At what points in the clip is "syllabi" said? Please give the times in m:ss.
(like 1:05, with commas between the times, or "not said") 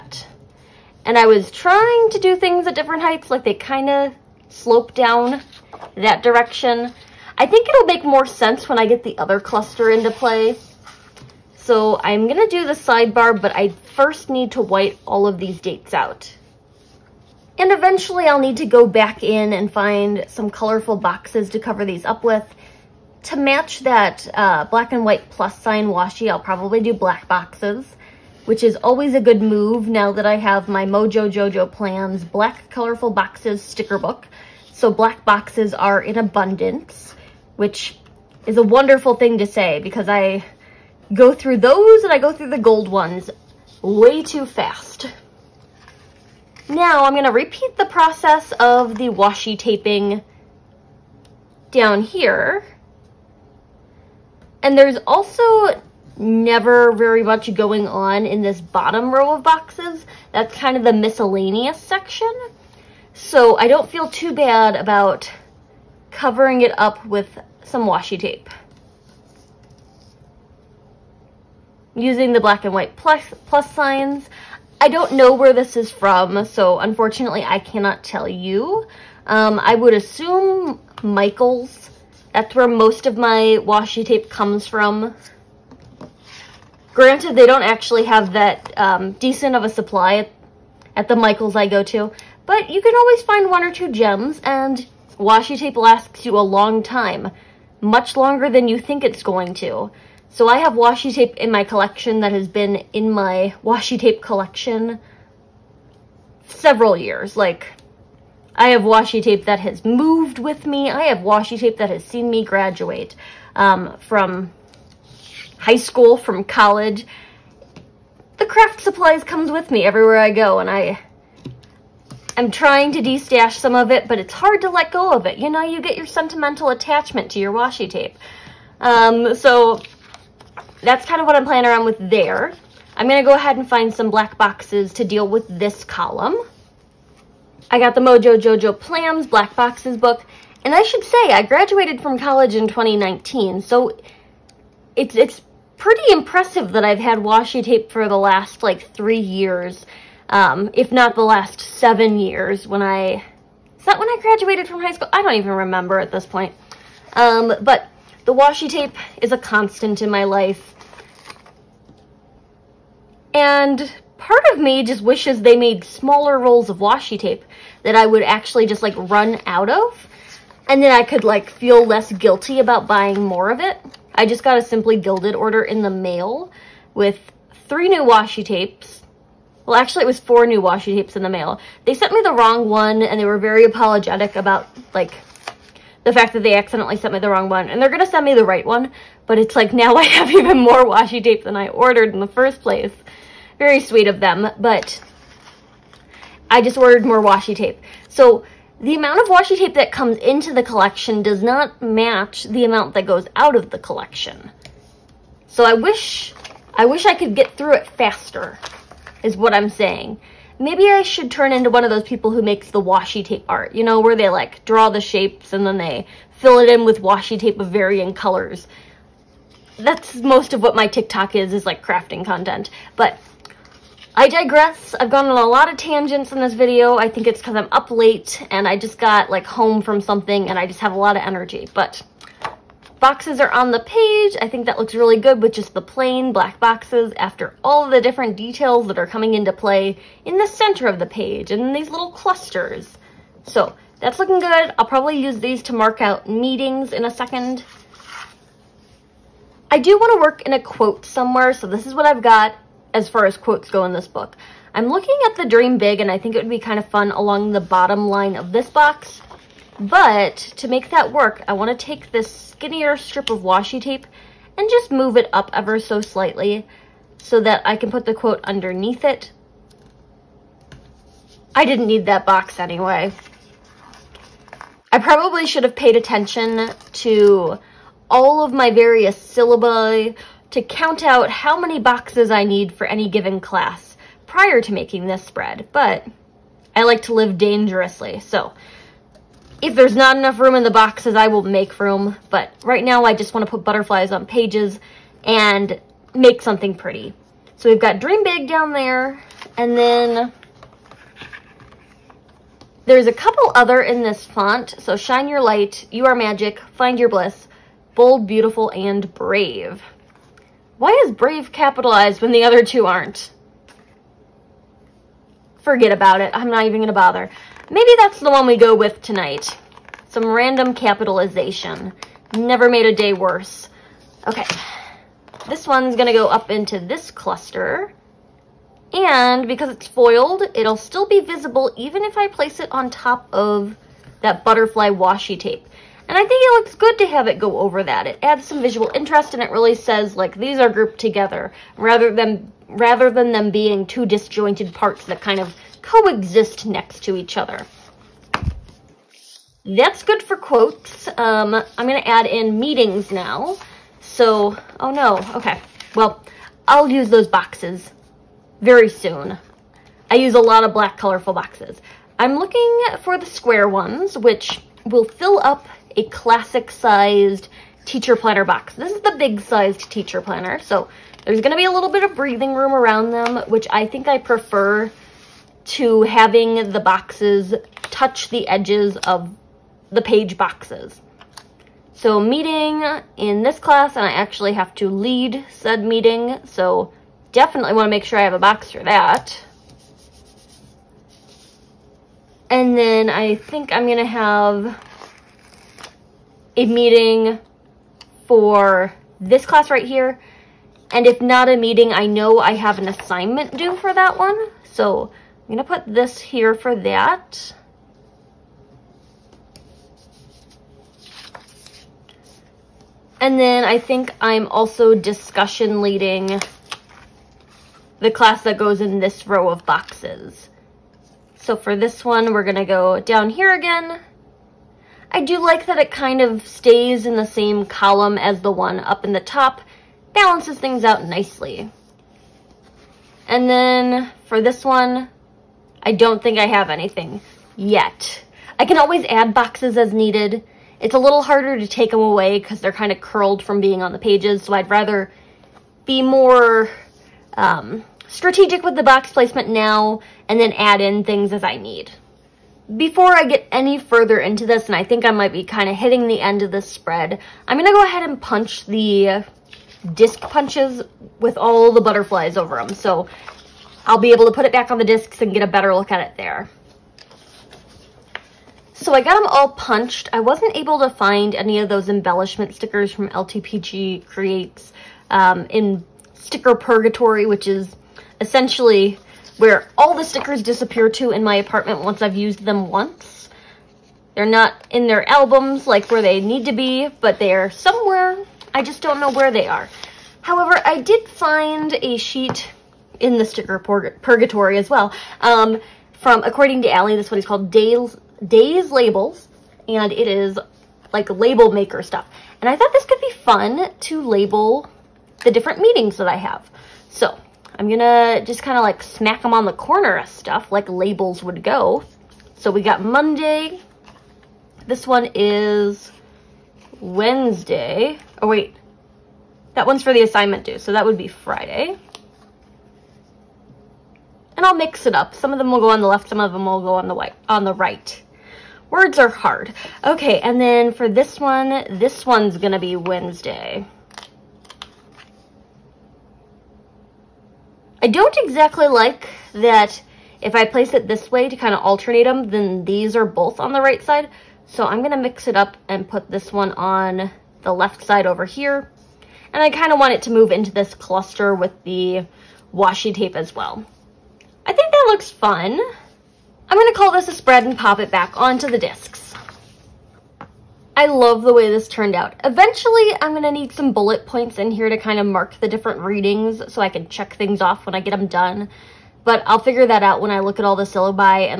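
4:39, 9:30.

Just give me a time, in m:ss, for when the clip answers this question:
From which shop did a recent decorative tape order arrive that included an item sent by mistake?
2:54.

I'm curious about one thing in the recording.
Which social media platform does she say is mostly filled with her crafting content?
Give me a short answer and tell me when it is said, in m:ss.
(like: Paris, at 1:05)
TikTok, at 3:40.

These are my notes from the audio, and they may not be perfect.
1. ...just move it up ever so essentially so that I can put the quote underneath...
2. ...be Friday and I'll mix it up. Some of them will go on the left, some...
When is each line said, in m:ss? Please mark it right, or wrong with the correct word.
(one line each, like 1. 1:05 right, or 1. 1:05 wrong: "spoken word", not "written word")
1. 4:24 wrong: "slightly", not "essentially"
2. 8:40 right.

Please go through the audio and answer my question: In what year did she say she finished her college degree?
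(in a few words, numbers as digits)
2019.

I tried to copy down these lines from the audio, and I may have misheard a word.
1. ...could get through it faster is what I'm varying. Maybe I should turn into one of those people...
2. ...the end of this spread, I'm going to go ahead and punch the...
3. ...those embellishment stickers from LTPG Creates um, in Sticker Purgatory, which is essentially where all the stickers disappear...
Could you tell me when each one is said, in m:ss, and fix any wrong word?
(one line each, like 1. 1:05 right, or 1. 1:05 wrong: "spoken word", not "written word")
1. 3:27 wrong: "saying", not "varying"
2. 7:36 right
3. 7:51 right.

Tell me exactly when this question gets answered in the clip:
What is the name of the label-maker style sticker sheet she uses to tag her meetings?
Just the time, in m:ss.
8:18.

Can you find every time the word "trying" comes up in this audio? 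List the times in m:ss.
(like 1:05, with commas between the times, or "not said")
0:01, 2:02.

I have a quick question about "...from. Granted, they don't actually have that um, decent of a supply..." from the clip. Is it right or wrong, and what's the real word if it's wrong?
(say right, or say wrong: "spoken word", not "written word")
right.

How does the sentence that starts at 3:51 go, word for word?
But boxes are on the page.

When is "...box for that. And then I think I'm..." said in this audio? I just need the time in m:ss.
6:28.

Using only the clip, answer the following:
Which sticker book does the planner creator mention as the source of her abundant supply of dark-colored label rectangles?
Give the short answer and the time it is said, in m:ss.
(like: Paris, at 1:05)
Mojo Jojo Plans Black Colorful Boxes, at 0:31.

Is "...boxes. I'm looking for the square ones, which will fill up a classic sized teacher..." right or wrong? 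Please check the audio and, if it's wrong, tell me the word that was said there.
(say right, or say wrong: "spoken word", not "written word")
right.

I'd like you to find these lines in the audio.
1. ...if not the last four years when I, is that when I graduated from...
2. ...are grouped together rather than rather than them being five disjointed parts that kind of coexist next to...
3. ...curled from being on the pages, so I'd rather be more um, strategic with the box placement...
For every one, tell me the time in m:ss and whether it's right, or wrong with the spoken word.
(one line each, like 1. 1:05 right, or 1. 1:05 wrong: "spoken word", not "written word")
1. 2:30 wrong: "seven", not "four"
2. 5:40 wrong: "two", not "five"
3. 7:23 right.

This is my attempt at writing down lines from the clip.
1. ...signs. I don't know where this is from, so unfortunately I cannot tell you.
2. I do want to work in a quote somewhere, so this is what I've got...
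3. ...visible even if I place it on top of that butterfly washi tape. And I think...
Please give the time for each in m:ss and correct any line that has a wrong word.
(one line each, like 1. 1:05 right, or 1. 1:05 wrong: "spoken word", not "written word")
1. 1:13 right
2. 4:09 right
3. 5:31 right.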